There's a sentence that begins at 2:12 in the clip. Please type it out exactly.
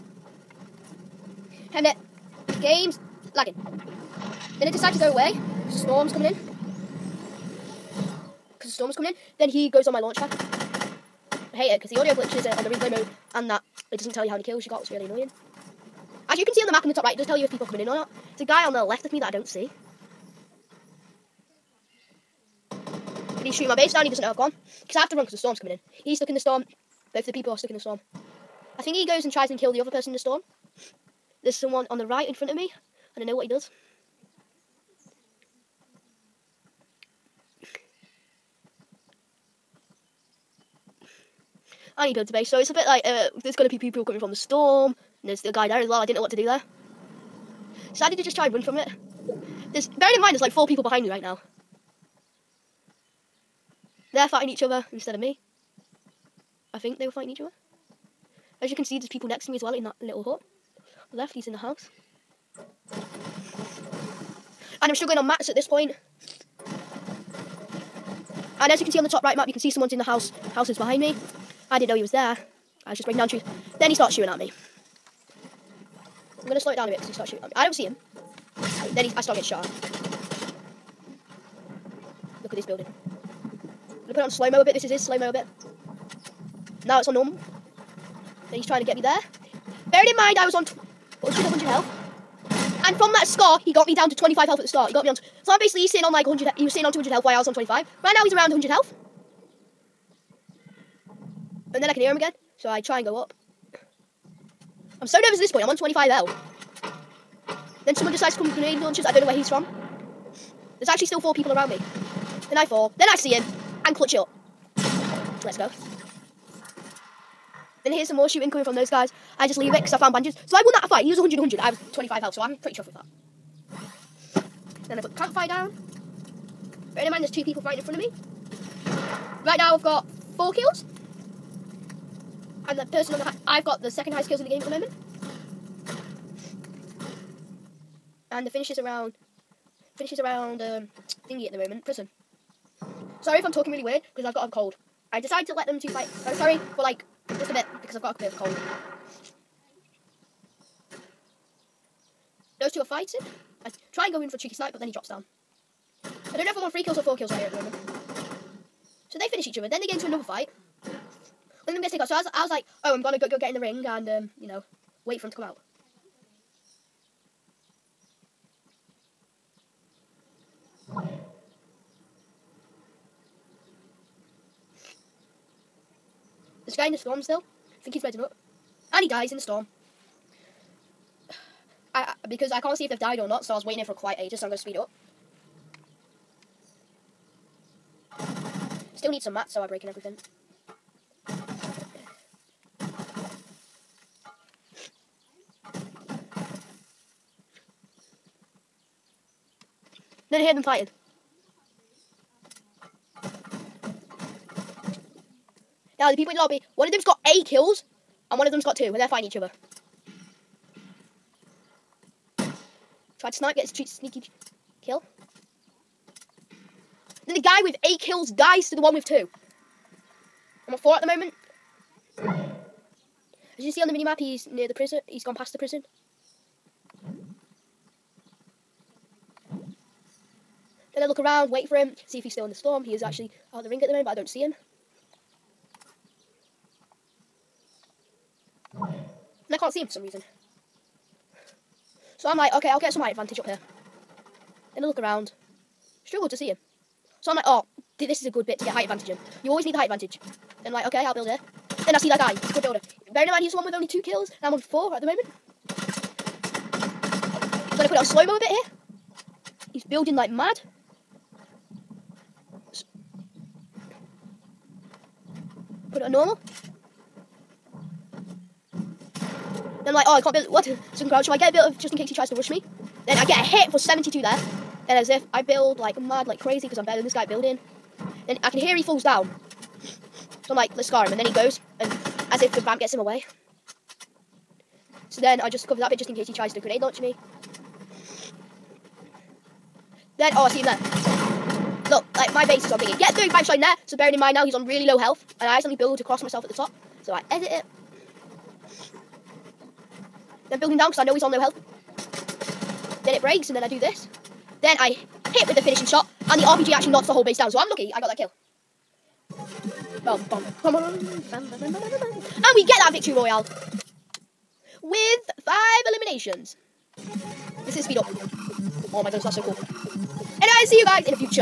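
And the person on the high, I've got the second highest kills in the game at the moment.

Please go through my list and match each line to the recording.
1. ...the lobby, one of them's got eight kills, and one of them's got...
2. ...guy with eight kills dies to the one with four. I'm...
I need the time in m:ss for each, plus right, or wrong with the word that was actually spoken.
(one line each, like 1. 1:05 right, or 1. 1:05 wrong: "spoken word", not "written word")
1. 3:26 right
2. 3:37 wrong: "two", not "four".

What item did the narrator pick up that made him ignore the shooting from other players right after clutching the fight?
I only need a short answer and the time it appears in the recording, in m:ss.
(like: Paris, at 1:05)
Bandages, at 1:59.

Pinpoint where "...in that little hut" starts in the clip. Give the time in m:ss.
0:59.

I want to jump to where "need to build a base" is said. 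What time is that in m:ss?
0:41.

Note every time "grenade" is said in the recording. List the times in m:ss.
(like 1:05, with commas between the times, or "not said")
1:48, 4:46.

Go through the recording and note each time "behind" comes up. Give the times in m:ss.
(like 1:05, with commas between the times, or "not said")
0:50, 1:10.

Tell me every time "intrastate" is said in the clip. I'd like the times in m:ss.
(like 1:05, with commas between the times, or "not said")
not said.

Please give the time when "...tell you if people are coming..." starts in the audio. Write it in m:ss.
0:17.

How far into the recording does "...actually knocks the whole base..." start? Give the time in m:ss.
5:06.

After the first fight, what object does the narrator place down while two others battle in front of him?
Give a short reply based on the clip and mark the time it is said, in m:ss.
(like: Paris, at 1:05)
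Campfire, at 2:04.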